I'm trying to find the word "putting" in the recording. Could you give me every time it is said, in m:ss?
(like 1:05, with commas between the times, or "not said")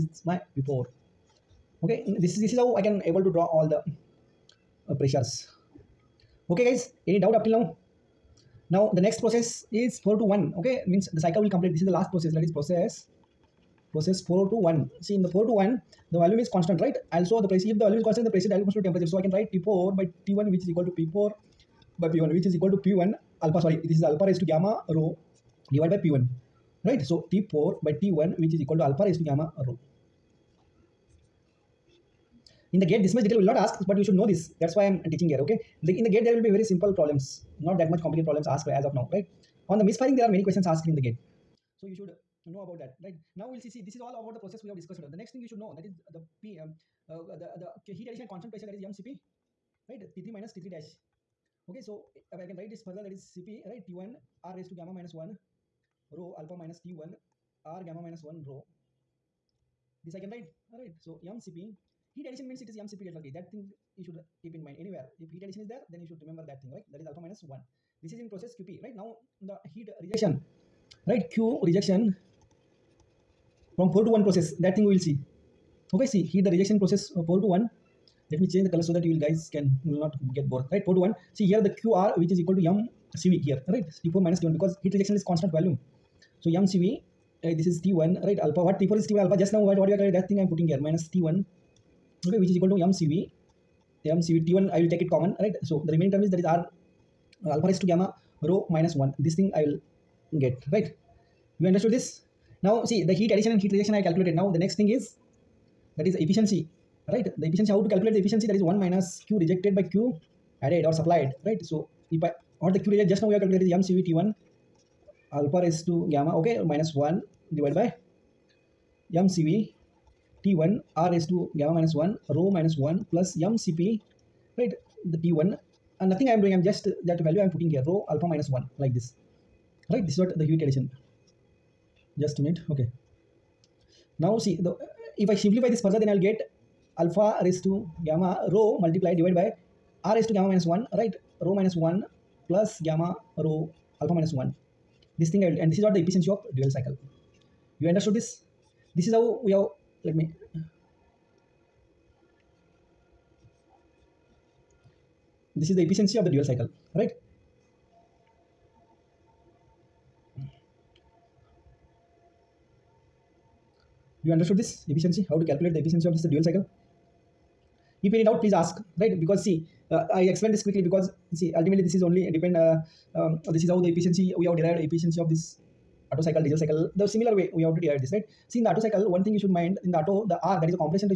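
1:30, 2:07.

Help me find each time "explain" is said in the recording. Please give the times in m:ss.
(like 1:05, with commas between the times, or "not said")
2:50.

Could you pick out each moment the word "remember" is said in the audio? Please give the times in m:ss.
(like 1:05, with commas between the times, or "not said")
1:06.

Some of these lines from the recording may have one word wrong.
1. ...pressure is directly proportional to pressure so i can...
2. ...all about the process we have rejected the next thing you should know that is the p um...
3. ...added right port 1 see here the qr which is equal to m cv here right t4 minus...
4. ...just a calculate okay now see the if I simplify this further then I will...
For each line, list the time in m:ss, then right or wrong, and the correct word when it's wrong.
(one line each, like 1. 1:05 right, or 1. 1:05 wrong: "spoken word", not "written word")
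1. 0:18 wrong: "temperature", not "pressure"
2. 0:44 wrong: "discussed", not "rejected"
3. 1:20 wrong: "bored", not "added"
4. 2:12 wrong: "minute", not "calculate".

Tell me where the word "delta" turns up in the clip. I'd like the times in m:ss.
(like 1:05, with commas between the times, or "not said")
1:03.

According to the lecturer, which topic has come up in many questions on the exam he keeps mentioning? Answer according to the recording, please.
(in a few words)
misfiring.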